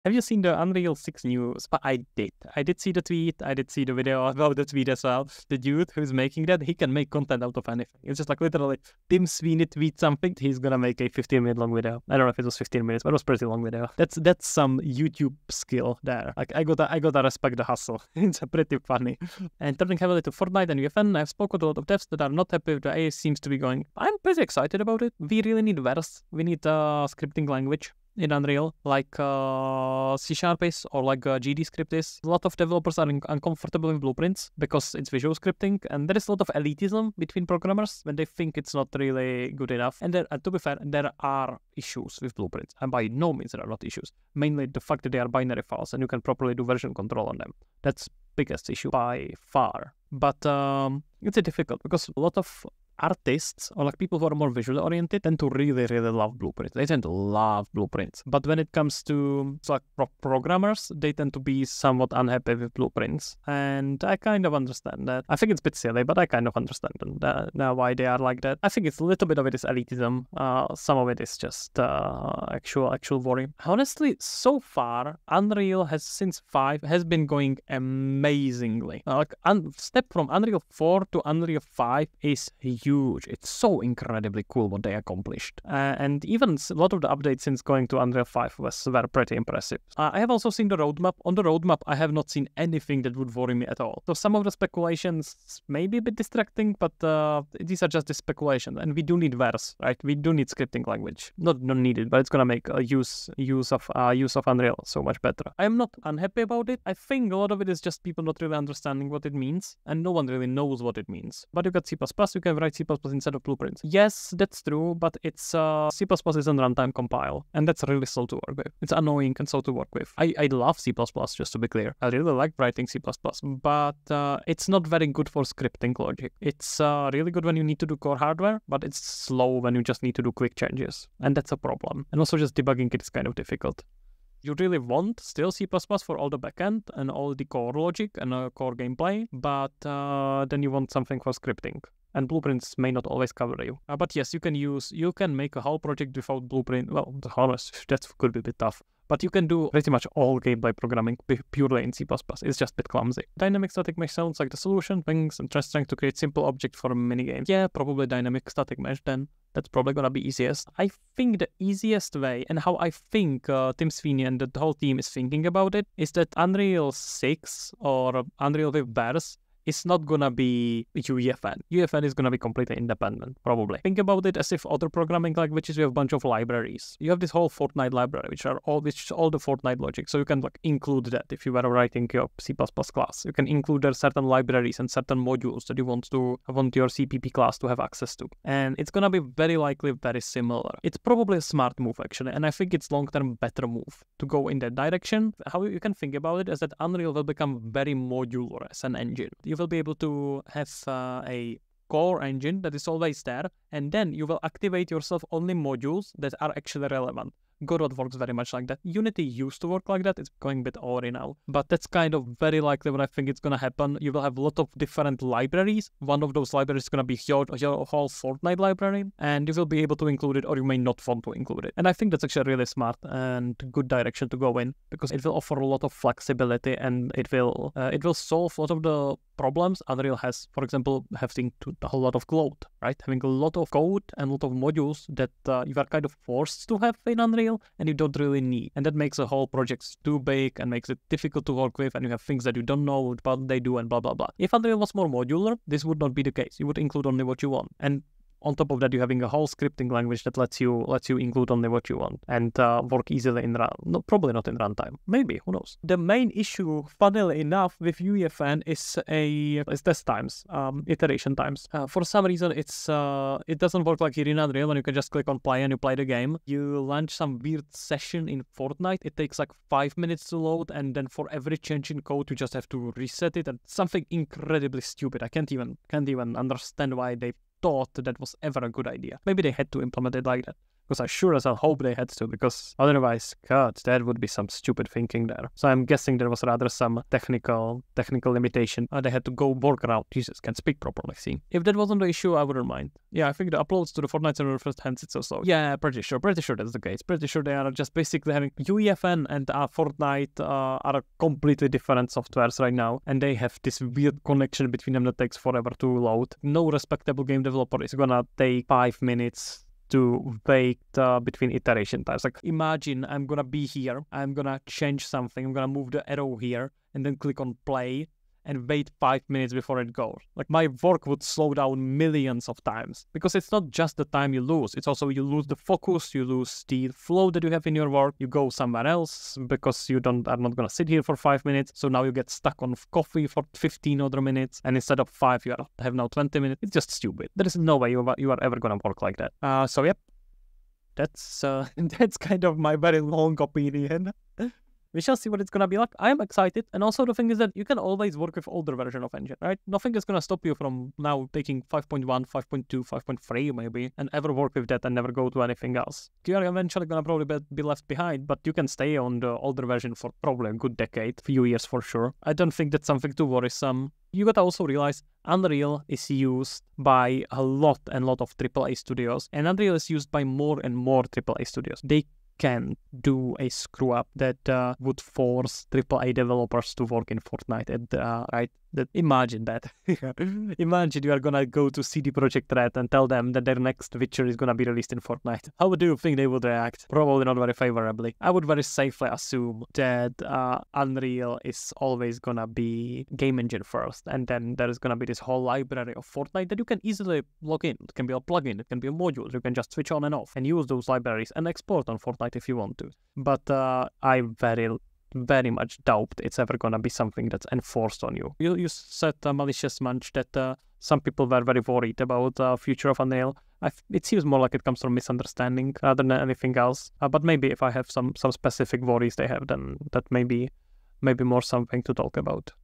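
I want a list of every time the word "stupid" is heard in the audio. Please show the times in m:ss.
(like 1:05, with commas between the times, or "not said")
4:34, 4:44, 5:36.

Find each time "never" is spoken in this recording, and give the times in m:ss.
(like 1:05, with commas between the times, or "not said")
5:54.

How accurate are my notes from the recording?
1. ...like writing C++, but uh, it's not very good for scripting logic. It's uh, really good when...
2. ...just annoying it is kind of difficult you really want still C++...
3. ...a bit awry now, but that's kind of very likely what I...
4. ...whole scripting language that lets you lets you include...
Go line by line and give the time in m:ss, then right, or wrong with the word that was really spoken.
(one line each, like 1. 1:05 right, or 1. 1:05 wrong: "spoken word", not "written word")
1. 2:02 right
2. 2:12 wrong: "debugging", not "annoying"
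3. 3:30 right
4. 4:09 right.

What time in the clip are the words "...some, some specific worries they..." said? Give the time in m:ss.
6:57.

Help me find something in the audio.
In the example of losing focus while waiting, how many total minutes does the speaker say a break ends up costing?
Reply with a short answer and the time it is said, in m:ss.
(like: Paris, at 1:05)
20 minutes, at 5:36.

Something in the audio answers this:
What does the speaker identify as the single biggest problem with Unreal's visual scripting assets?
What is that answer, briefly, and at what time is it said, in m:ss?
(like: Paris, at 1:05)
They are binary files, at 0:45.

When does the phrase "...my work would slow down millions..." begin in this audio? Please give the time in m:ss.
5:20.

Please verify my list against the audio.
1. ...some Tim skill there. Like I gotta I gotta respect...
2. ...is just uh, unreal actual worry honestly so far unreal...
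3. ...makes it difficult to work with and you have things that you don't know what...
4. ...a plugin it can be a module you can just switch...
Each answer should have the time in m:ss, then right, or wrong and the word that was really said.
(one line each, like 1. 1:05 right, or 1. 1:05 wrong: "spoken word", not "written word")
1. 0:14 wrong: "YouTube", not "Tim"
2. 1:11 wrong: "actual", not "unreal"
3. 4:00 right
4. 6:38 right.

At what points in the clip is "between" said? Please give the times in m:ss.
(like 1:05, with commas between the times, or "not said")
0:37, 5:04, 5:11.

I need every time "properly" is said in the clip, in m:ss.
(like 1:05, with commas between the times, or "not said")
0:46, 4:50.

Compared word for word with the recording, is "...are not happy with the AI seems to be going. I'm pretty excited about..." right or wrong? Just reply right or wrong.
right.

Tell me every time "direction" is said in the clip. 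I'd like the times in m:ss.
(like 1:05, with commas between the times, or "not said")
3:14, 3:43.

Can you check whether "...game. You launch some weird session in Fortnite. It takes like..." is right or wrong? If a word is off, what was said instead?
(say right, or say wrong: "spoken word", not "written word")
right.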